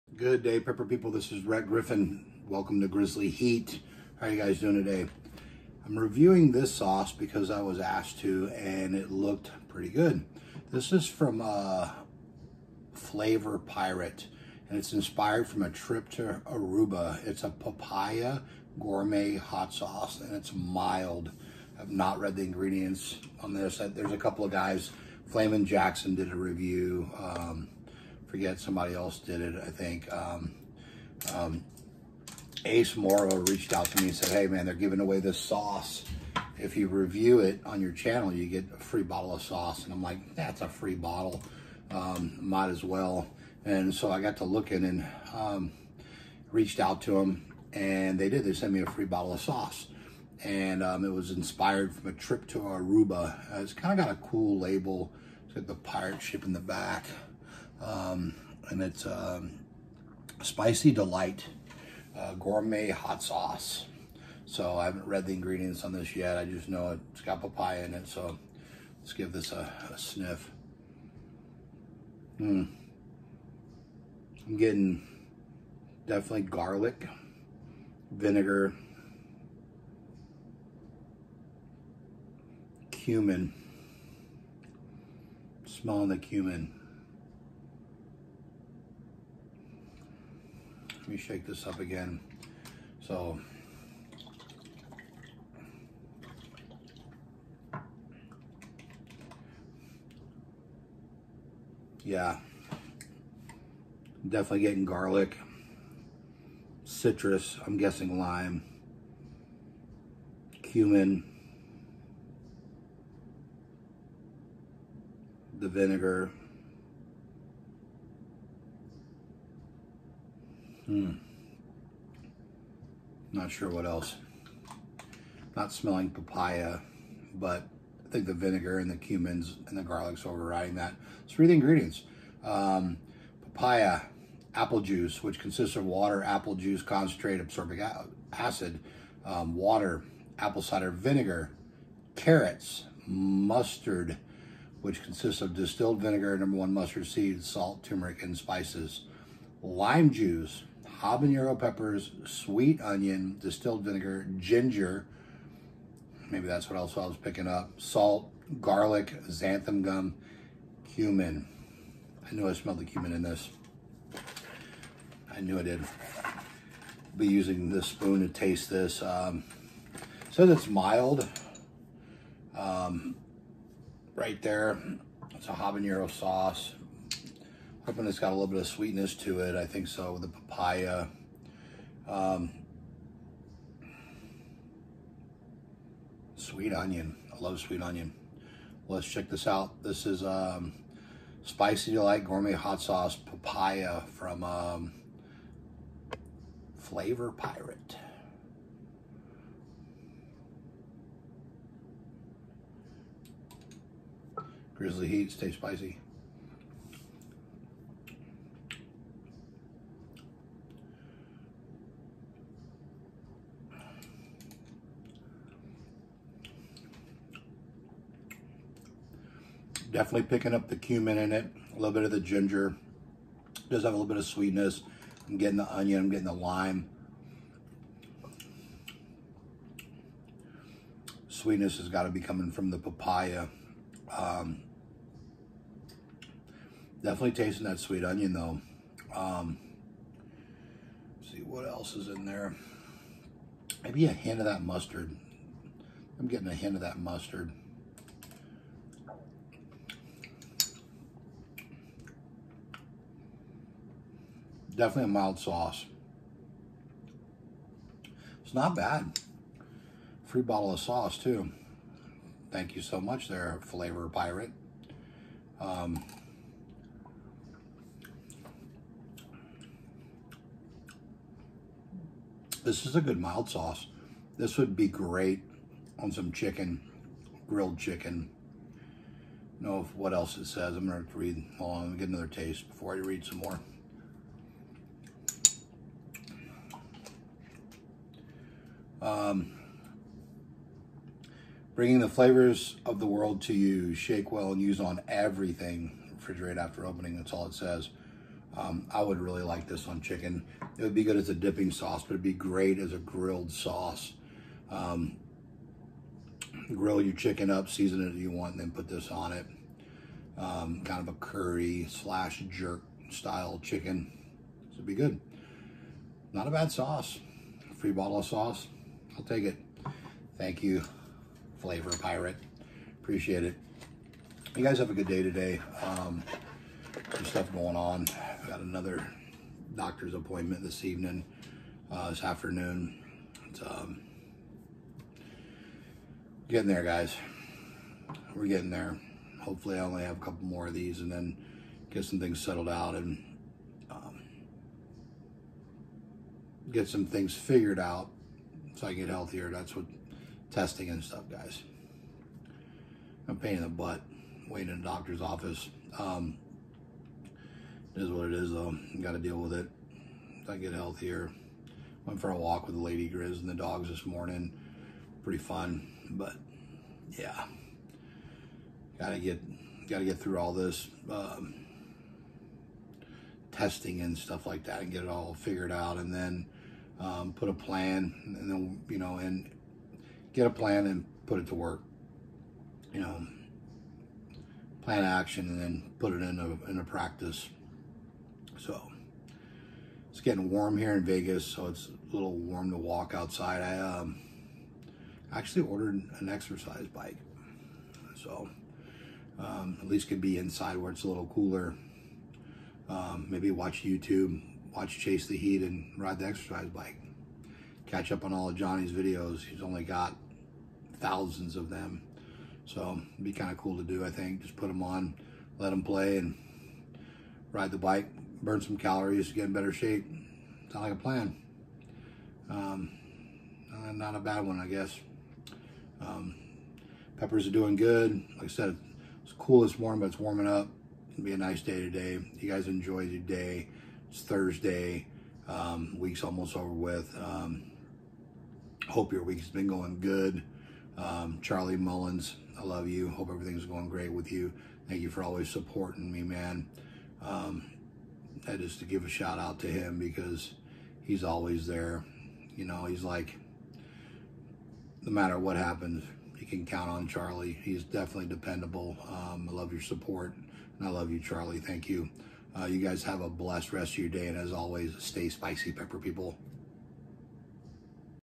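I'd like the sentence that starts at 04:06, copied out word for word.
I'm getting a hint of that mustard.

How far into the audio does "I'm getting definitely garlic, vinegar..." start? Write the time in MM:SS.
01:14.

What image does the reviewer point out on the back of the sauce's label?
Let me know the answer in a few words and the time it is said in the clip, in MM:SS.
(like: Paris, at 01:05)
pirate ship, at 00:55.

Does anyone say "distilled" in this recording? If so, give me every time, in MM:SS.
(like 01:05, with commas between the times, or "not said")
02:25, 02:33.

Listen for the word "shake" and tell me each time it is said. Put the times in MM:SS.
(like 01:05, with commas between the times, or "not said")
01:31, 04:53.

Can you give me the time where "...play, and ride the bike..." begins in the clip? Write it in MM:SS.
06:55.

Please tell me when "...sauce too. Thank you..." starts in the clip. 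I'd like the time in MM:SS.
04:20.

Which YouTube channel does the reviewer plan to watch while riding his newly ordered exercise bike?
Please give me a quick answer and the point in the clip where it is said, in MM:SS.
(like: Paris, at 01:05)
Chase the Heat, at 06:44.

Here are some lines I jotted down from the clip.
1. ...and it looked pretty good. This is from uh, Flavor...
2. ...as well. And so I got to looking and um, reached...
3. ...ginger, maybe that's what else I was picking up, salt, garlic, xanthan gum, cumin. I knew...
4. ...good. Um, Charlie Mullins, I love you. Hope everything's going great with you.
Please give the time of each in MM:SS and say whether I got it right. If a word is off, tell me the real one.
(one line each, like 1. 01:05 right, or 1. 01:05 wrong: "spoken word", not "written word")
1. 00:08 right
2. 00:42 right
3. 02:34 right
4. 07:20 right.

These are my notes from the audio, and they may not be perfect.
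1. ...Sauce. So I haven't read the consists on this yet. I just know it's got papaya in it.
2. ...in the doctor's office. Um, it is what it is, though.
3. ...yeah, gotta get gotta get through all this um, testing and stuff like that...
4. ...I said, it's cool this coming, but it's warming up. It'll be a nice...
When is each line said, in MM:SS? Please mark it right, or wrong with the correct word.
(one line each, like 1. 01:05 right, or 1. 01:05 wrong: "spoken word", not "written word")
1. 01:03 wrong: "ingredients", not "consists"
2. 05:54 right
3. 06:07 right
4. 07:08 wrong: "morning", not "coming".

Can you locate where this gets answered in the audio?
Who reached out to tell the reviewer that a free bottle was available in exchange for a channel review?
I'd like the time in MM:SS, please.
00:32.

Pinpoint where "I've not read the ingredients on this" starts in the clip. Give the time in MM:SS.
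00:21.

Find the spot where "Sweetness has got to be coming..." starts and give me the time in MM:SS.
03:51.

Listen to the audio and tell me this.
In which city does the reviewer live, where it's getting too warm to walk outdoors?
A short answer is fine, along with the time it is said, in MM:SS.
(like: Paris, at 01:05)
Vegas, at 06:31.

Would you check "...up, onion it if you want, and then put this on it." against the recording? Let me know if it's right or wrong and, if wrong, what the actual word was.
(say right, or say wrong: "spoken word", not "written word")
wrong: "season", not "onion".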